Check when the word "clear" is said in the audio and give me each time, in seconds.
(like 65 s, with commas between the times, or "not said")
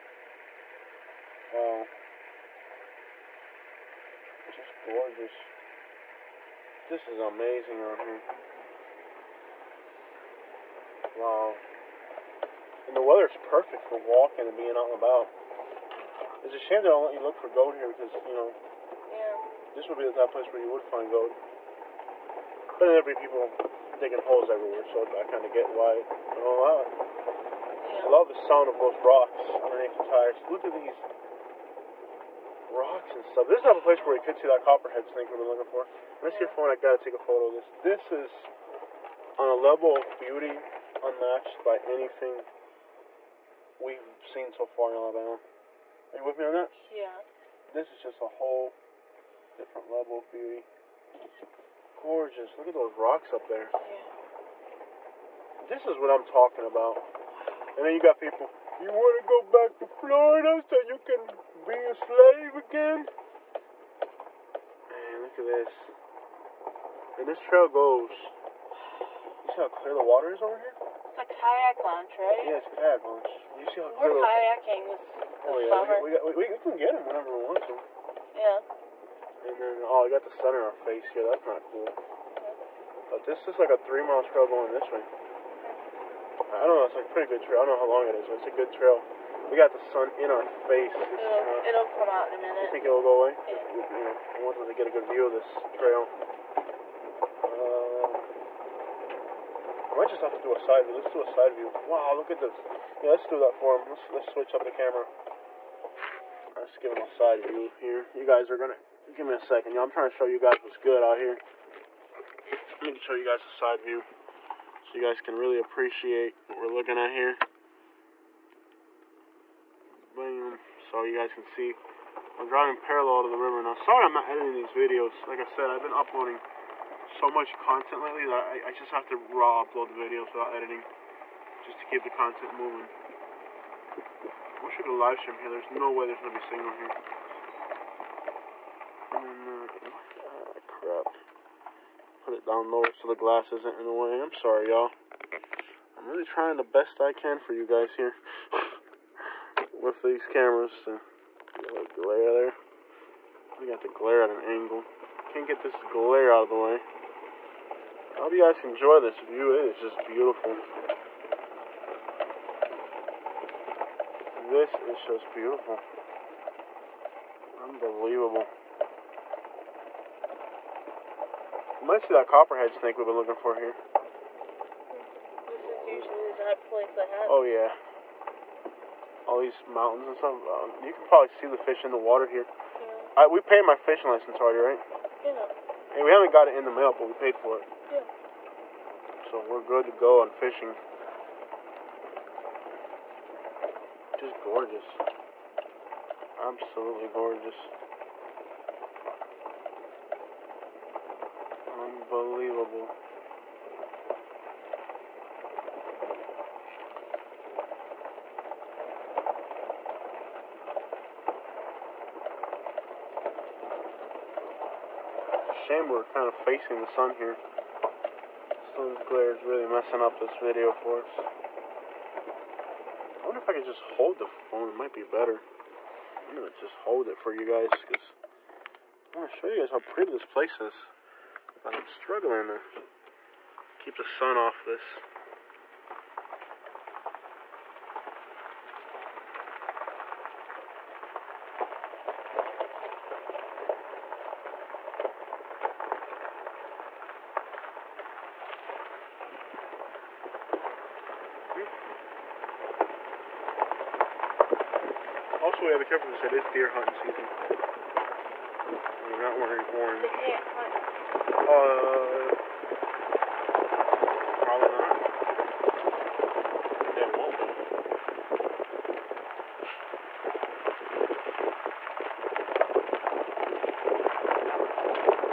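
69 s, 74 s.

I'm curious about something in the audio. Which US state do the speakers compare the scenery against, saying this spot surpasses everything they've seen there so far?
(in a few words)
Alabama.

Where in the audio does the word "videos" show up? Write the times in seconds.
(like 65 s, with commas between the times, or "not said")
124 s, 129 s, 220 s.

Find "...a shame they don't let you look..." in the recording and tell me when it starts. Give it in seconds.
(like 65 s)
16 s.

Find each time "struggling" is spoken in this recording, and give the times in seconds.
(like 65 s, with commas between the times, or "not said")
231 s.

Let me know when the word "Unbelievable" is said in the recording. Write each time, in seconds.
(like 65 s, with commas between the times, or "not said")
167 s, 201 s.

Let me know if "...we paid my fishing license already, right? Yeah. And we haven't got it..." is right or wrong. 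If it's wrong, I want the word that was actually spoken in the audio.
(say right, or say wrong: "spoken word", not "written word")
right.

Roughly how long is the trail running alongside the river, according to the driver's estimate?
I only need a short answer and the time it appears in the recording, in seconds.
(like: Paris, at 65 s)
3 miles, at 83 s.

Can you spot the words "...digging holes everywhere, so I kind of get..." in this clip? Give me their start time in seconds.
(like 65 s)
23 s.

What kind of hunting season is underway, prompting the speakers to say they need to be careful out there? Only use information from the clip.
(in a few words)
Deer hunting season.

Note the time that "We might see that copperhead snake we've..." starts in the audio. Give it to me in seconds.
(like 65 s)
171 s.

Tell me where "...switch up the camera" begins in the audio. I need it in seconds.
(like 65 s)
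104 s.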